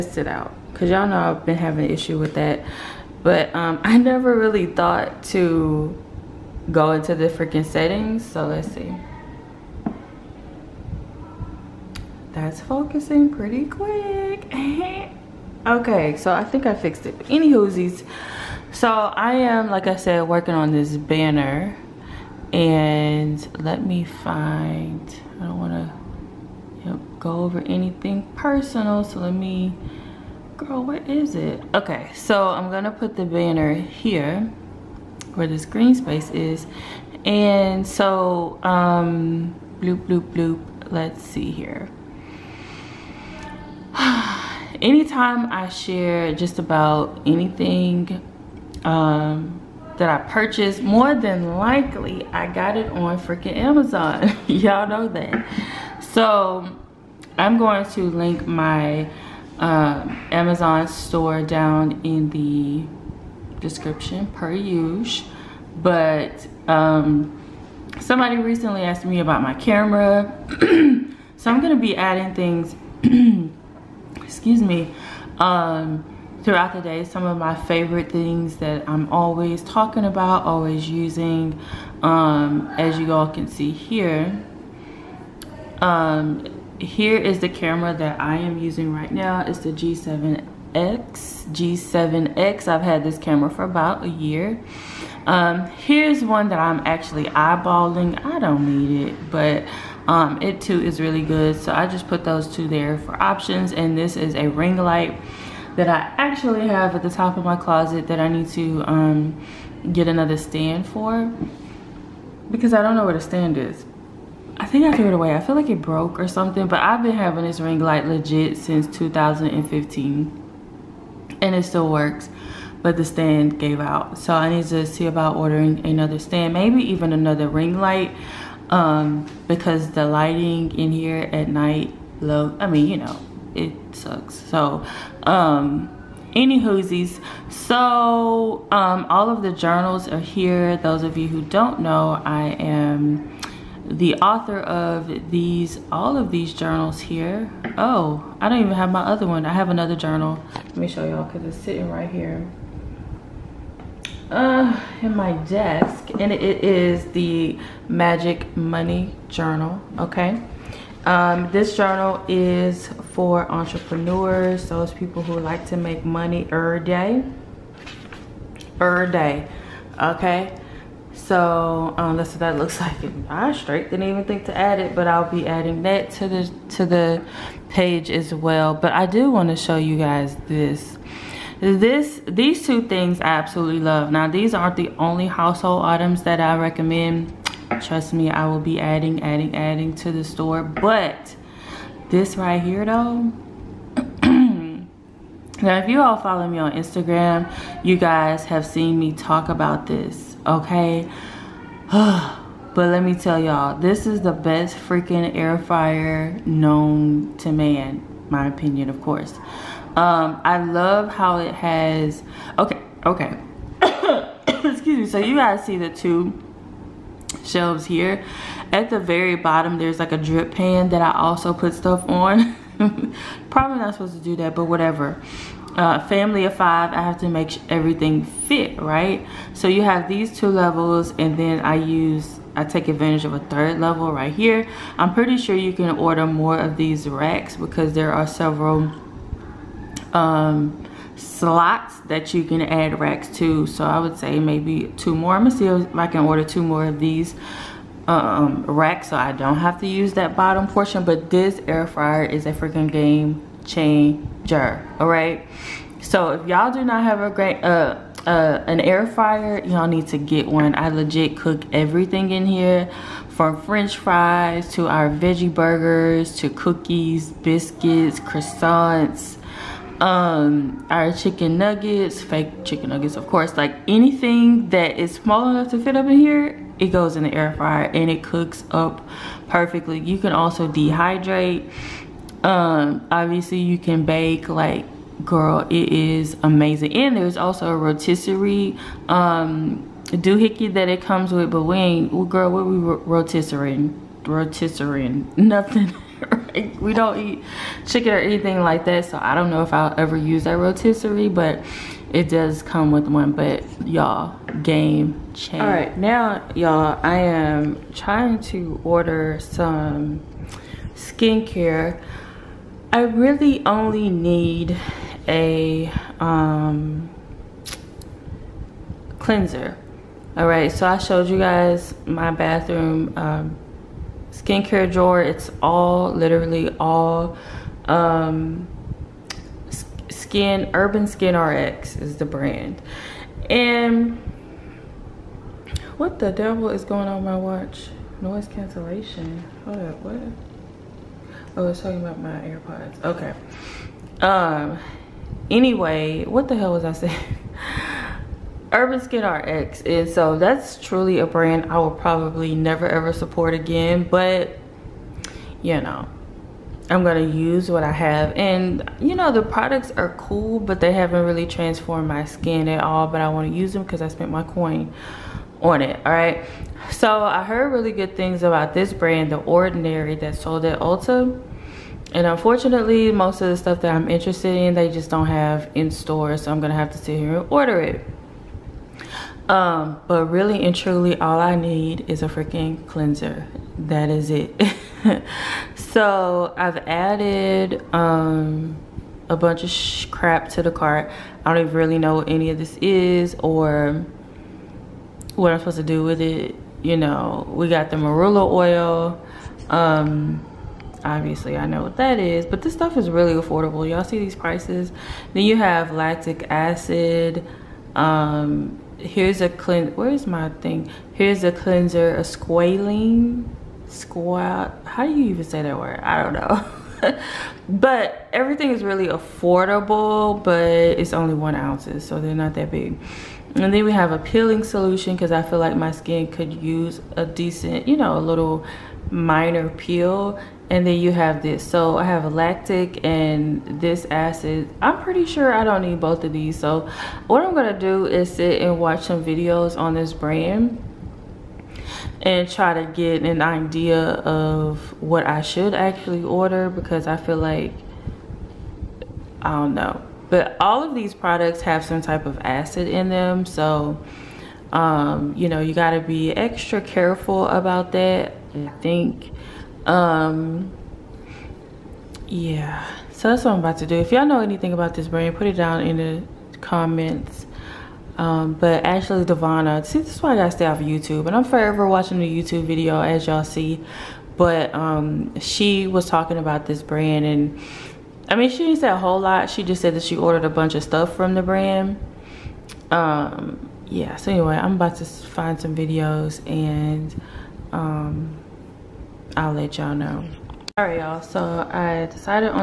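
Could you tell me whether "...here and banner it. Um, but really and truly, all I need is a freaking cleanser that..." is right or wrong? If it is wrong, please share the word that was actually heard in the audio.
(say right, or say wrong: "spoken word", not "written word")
wrong: "order", not "banner".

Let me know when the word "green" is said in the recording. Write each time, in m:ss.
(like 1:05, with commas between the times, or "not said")
0:35.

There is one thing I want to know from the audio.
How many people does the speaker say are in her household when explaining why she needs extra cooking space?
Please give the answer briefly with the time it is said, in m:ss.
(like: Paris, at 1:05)
5, at 3:46.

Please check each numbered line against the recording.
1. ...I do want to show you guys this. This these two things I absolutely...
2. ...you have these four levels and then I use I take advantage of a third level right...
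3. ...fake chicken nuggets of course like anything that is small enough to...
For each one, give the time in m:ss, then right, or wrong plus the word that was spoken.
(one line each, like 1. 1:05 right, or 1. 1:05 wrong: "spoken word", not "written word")
1. 2:58 right
2. 3:49 wrong: "two", not "four"
3. 4:32 right.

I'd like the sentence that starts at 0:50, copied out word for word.
More than likely, I got it on freaking Amazon.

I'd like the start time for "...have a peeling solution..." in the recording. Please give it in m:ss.
7:03.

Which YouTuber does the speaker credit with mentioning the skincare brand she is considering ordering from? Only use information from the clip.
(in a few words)
Ashley Devana.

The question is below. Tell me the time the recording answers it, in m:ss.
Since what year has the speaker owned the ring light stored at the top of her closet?
1:58.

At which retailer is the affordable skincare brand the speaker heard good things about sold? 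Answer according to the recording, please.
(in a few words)
Ulta.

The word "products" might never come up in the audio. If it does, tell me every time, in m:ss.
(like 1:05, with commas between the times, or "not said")
5:59, 7:31.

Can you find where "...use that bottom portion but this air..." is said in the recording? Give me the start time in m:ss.
4:09.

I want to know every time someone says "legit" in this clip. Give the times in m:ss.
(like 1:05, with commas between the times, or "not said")
1:58, 4:20.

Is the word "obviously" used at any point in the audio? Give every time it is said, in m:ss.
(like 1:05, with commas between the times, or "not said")
4:43, 6:41.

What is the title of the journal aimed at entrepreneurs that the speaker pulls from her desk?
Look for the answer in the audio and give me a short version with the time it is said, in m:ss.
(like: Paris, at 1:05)
Magic Money Journal, at 2:37.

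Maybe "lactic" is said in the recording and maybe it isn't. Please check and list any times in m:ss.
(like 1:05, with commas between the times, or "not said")
6:45, 7:12.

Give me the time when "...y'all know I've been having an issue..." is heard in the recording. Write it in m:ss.
0:00.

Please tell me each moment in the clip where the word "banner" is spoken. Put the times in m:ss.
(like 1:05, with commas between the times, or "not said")
0:20, 0:33.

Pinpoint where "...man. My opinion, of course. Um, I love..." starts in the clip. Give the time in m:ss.
3:27.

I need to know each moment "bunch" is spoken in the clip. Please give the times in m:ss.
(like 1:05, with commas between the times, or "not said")
6:29, 8:00.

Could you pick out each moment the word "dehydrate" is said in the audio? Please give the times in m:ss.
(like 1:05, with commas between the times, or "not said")
4:40.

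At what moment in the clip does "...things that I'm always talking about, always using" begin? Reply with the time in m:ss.
1:18.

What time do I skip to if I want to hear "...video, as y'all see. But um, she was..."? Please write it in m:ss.
7:52.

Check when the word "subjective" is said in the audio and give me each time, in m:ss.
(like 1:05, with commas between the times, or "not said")
not said.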